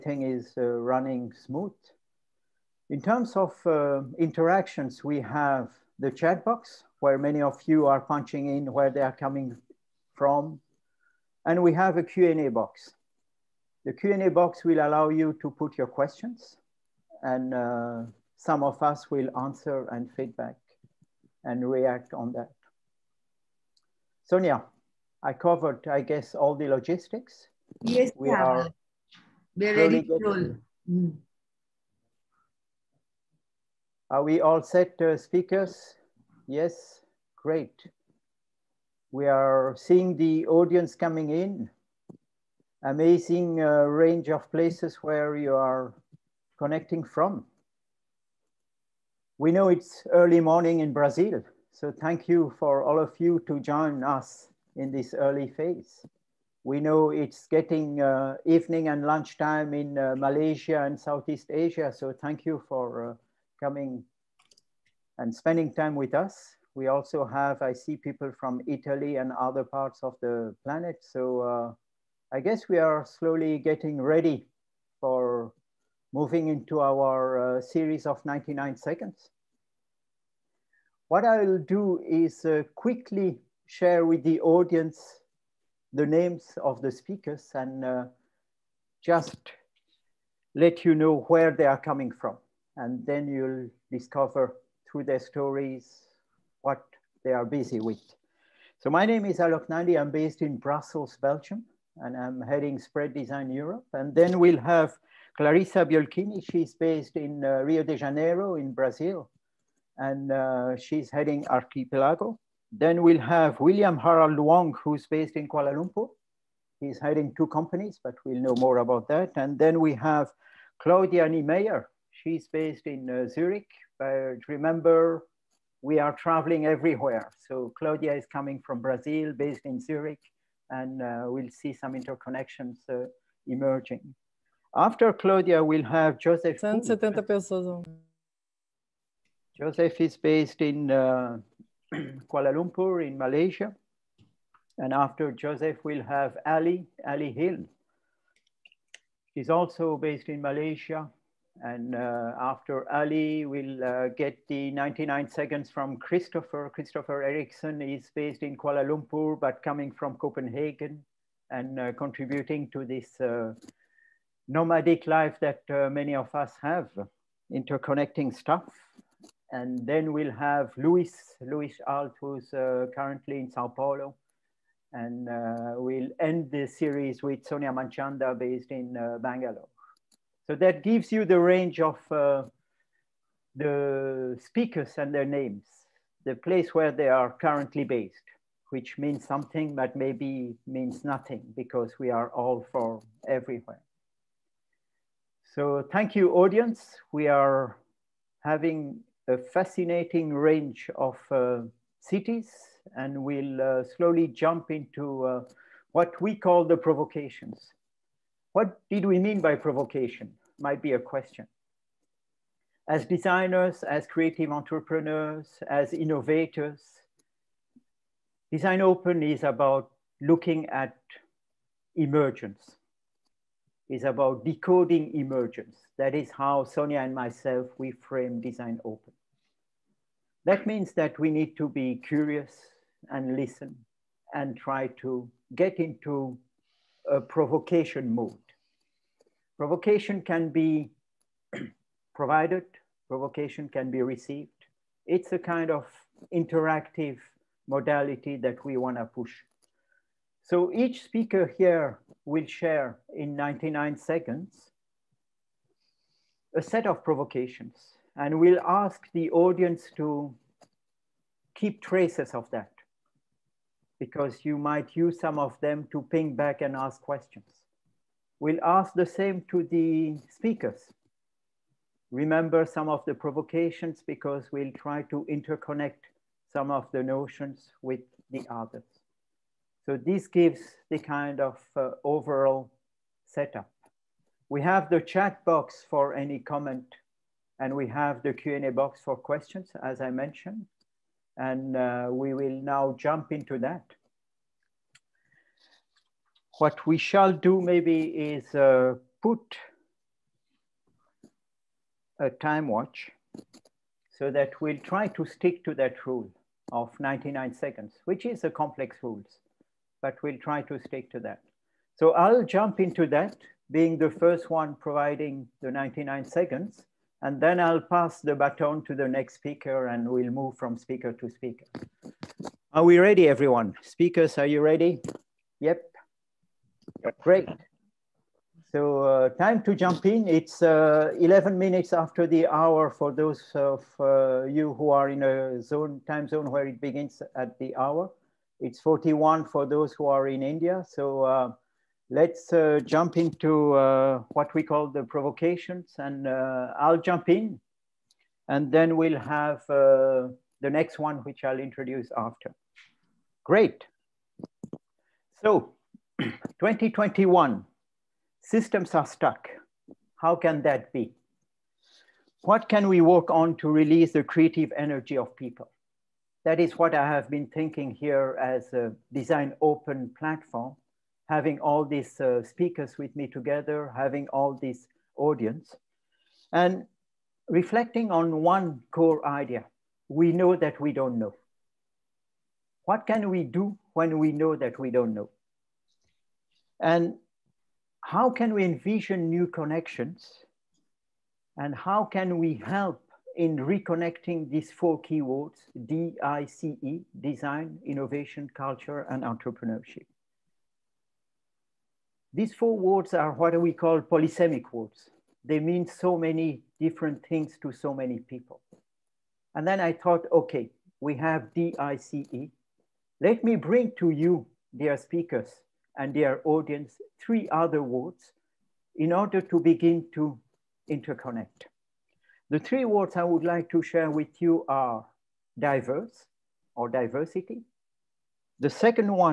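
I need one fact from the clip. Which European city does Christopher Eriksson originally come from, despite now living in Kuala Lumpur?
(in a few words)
Copenhagen.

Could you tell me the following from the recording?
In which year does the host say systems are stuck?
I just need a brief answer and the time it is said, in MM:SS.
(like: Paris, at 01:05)
2021, at 05:56.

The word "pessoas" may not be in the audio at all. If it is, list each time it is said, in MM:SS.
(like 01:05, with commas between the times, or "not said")
02:17.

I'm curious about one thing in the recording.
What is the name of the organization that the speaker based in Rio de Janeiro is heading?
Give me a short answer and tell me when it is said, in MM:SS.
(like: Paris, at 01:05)
Archipelago, at 01:51.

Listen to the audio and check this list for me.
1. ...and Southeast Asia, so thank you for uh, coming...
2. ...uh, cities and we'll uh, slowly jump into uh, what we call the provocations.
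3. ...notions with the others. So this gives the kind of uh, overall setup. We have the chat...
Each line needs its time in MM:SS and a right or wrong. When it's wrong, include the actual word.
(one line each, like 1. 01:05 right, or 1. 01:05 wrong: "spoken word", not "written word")
1. 01:00 right
2. 03:21 right
3. 04:37 right.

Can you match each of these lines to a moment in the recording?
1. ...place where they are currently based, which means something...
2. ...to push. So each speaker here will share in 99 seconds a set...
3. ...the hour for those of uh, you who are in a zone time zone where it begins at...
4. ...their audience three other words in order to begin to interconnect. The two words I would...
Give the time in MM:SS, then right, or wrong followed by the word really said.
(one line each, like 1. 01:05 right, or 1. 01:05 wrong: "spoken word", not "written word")
1. 03:06 right
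2. 04:08 right
3. 05:32 right
4. 06:56 wrong: "three", not "two".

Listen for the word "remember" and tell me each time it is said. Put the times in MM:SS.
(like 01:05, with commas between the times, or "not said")
02:04, 04:32.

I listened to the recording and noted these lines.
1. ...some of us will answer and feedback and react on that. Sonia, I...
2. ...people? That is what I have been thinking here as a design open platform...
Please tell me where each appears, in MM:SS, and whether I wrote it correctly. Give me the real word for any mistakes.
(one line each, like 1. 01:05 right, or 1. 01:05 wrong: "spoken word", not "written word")
1. 00:18 right
2. 06:05 right.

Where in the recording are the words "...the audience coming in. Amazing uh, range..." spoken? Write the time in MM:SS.
00:40.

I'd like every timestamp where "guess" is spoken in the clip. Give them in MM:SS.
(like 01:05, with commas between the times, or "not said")
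00:26, 01:12.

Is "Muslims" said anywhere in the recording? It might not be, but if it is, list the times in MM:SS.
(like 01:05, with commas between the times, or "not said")
not said.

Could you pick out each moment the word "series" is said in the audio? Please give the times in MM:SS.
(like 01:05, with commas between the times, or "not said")
01:17, 02:56.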